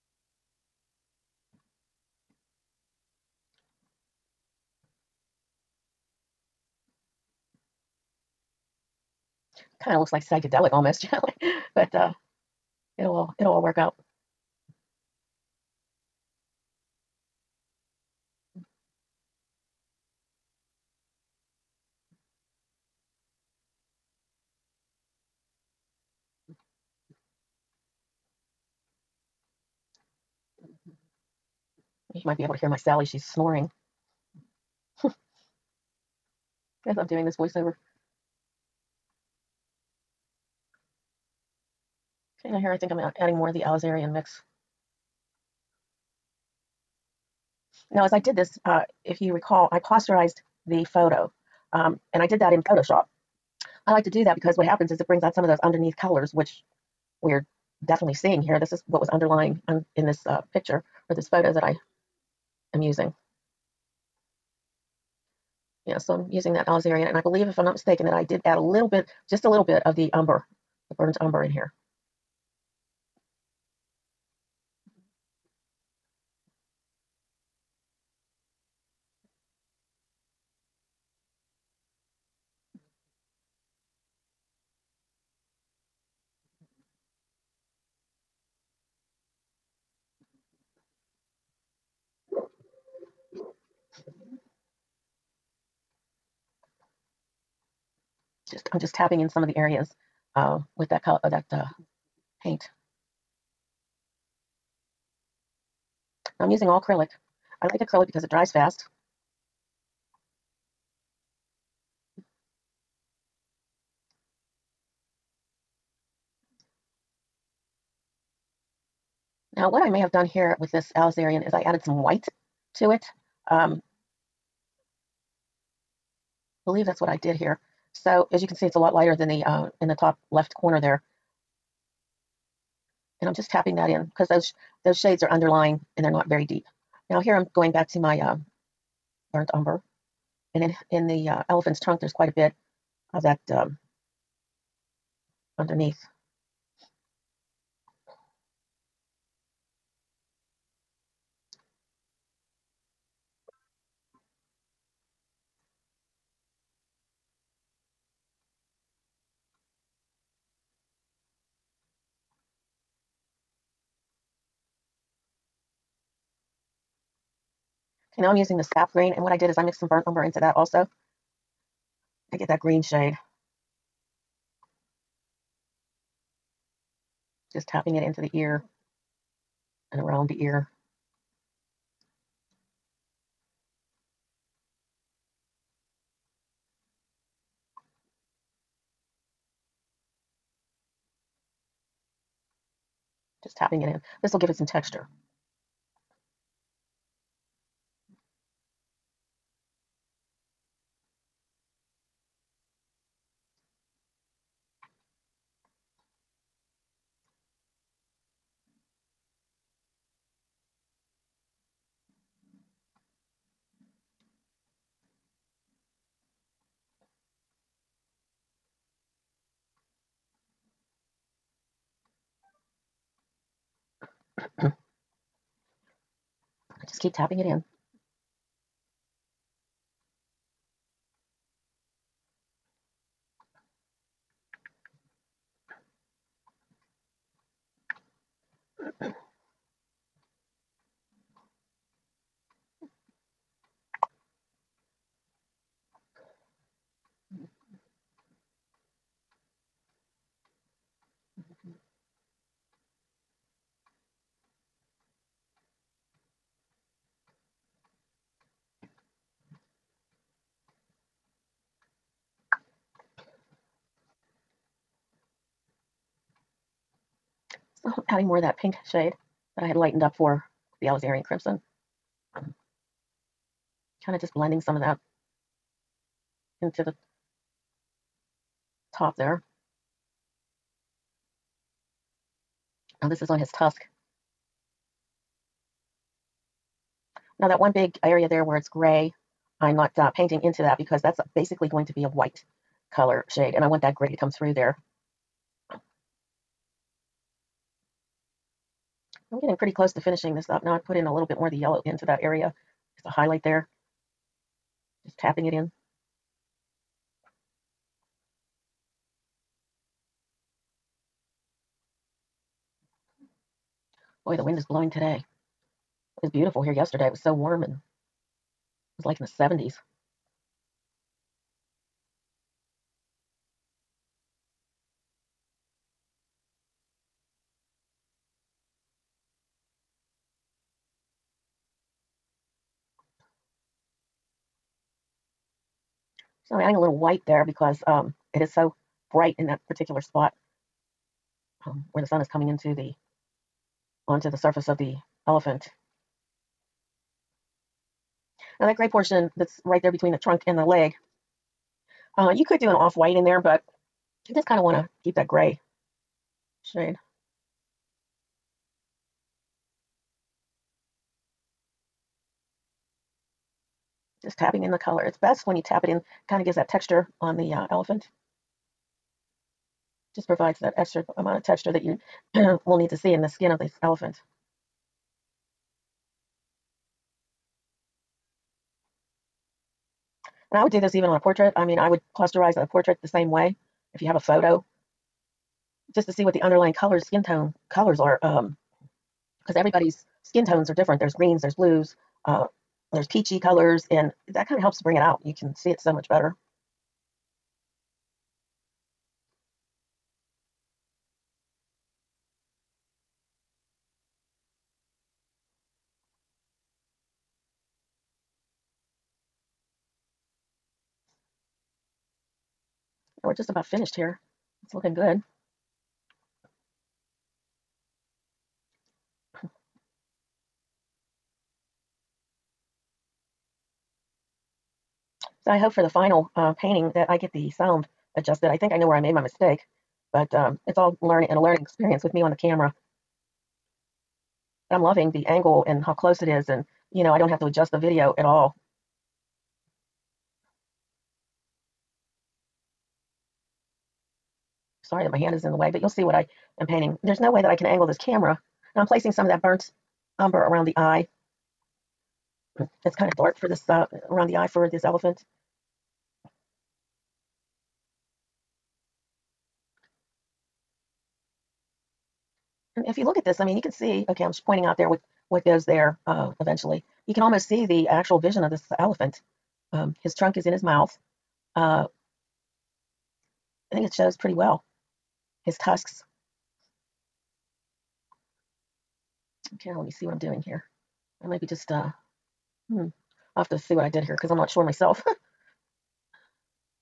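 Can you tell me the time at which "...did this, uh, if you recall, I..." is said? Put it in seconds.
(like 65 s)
48 s.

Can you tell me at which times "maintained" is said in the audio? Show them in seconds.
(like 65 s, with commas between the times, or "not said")
not said.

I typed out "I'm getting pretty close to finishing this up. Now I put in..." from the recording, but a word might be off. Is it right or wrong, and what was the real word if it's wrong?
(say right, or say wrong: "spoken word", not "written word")
right.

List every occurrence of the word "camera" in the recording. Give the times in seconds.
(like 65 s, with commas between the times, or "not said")
432 s, 447 s.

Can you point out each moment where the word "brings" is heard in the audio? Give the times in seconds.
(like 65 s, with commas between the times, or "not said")
55 s, 394 s.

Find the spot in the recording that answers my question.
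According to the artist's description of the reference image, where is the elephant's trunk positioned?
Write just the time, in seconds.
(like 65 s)
470 s.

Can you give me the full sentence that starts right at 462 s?
if you look at this, I mean, you can see, okay, I'm pointing out there what, what goes there uh, eventually.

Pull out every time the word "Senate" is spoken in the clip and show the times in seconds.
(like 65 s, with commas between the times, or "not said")
not said.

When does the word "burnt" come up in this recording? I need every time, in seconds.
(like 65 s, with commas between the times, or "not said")
70 s, 139 s, 169 s, 449 s.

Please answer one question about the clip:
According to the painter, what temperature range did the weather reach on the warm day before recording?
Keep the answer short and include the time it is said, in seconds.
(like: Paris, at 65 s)
The 70s, at 319 s.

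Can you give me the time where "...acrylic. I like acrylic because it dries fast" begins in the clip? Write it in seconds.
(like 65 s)
106 s.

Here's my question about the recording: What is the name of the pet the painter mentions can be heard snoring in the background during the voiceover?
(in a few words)
Sally.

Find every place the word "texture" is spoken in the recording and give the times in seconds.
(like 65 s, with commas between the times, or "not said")
194 s, 366 s, 371 s.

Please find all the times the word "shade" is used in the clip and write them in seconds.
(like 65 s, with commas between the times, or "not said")
134 s, 172 s, 268 s, 293 s, 356 s.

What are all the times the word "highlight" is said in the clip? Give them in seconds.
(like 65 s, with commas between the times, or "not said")
303 s.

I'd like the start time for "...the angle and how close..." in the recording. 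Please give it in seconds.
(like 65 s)
435 s.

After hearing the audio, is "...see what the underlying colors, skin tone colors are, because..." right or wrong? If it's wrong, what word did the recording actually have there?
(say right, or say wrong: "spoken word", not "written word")
right.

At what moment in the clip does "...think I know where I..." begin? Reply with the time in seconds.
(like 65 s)
428 s.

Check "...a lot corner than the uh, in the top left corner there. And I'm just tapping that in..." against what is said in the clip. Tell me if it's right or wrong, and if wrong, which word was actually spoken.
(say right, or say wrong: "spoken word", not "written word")
wrong: "lighter", not "corner".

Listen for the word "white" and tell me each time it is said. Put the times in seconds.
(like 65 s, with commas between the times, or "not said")
122 s, 292 s, 336 s, 352 s.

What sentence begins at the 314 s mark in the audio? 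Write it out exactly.
Boy, the wind is blowing today.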